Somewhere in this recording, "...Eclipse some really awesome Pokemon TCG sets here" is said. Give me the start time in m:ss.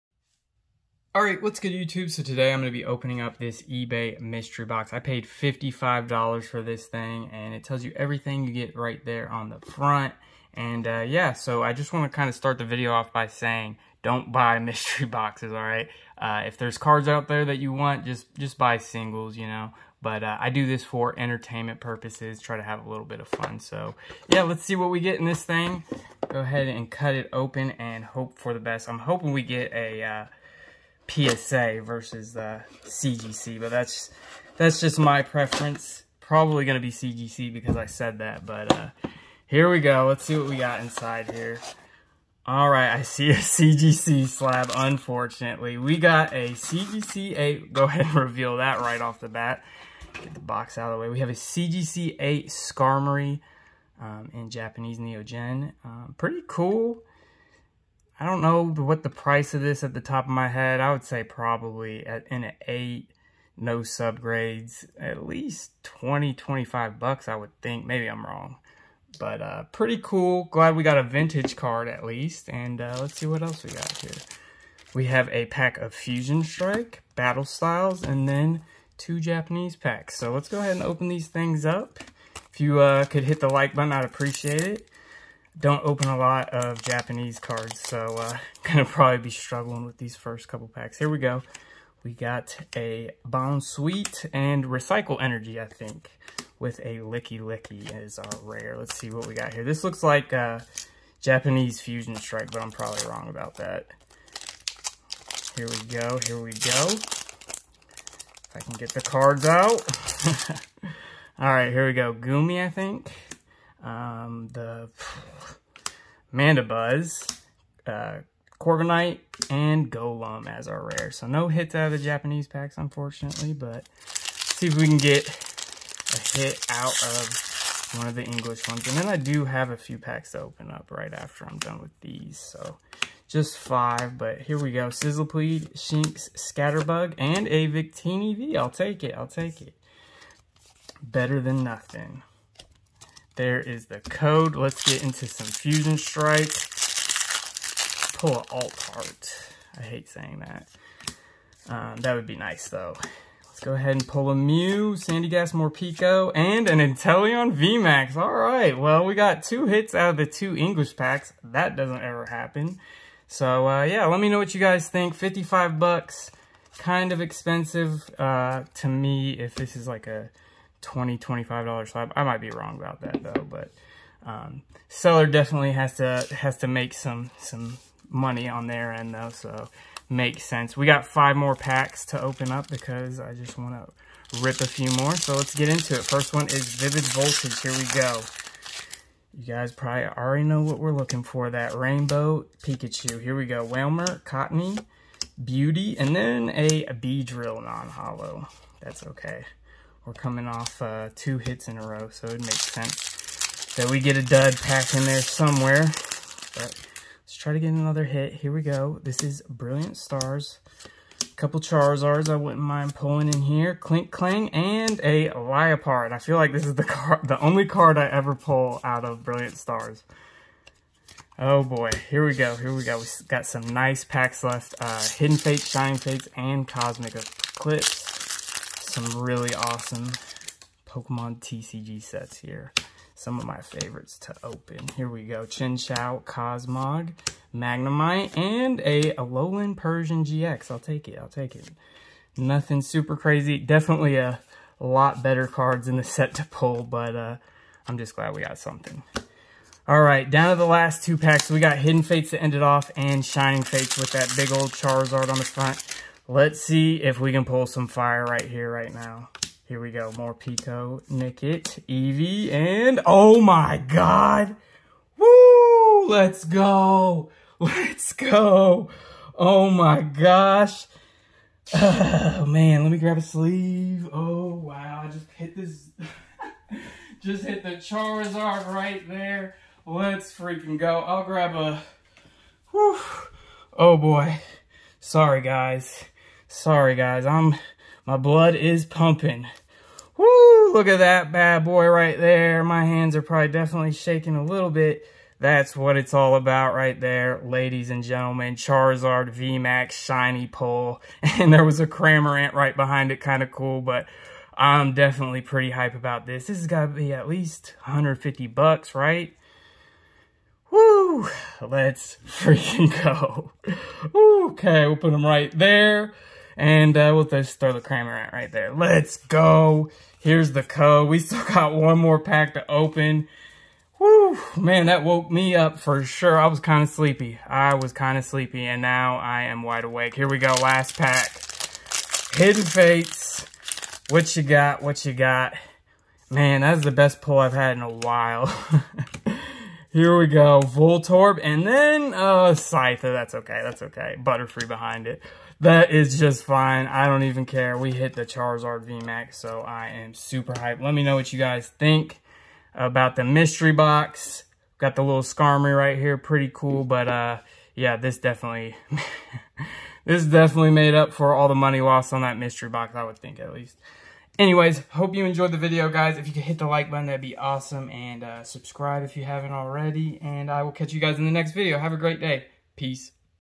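3:47.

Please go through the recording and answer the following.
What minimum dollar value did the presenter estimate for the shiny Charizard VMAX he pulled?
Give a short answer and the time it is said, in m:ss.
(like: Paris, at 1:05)
$150, at 5:07.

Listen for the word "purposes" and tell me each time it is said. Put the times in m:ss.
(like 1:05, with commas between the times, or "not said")
0:21.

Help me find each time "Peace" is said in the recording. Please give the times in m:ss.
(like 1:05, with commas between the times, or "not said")
6:12.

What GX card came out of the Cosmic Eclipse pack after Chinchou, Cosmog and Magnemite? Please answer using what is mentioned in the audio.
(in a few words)
Alolan Persian GX.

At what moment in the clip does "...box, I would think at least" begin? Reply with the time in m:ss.
6:02.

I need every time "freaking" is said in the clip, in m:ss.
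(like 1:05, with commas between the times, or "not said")
4:40, 5:12.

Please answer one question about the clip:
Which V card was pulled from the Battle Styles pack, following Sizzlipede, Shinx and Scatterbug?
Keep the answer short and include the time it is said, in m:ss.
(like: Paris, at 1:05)
Victini V, at 2:17.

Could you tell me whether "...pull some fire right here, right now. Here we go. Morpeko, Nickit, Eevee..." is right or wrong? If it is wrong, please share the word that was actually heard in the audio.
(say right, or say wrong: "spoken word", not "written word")
right.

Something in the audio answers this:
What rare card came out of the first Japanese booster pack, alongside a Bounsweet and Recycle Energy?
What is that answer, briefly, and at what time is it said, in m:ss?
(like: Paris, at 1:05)
Lickilicky, at 1:36.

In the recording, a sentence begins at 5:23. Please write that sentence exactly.
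Whew, man, that woke me up for sure.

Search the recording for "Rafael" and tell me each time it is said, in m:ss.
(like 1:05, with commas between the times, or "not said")
not said.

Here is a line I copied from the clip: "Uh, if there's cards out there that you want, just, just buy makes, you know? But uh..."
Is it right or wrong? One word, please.
wrong.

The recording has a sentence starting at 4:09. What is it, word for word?
All right, down to the last two packs.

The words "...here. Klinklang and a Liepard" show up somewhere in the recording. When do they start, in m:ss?
3:33.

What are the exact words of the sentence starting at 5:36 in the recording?
Man, that's the best pull I've had in a while.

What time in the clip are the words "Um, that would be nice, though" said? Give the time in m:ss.
2:31.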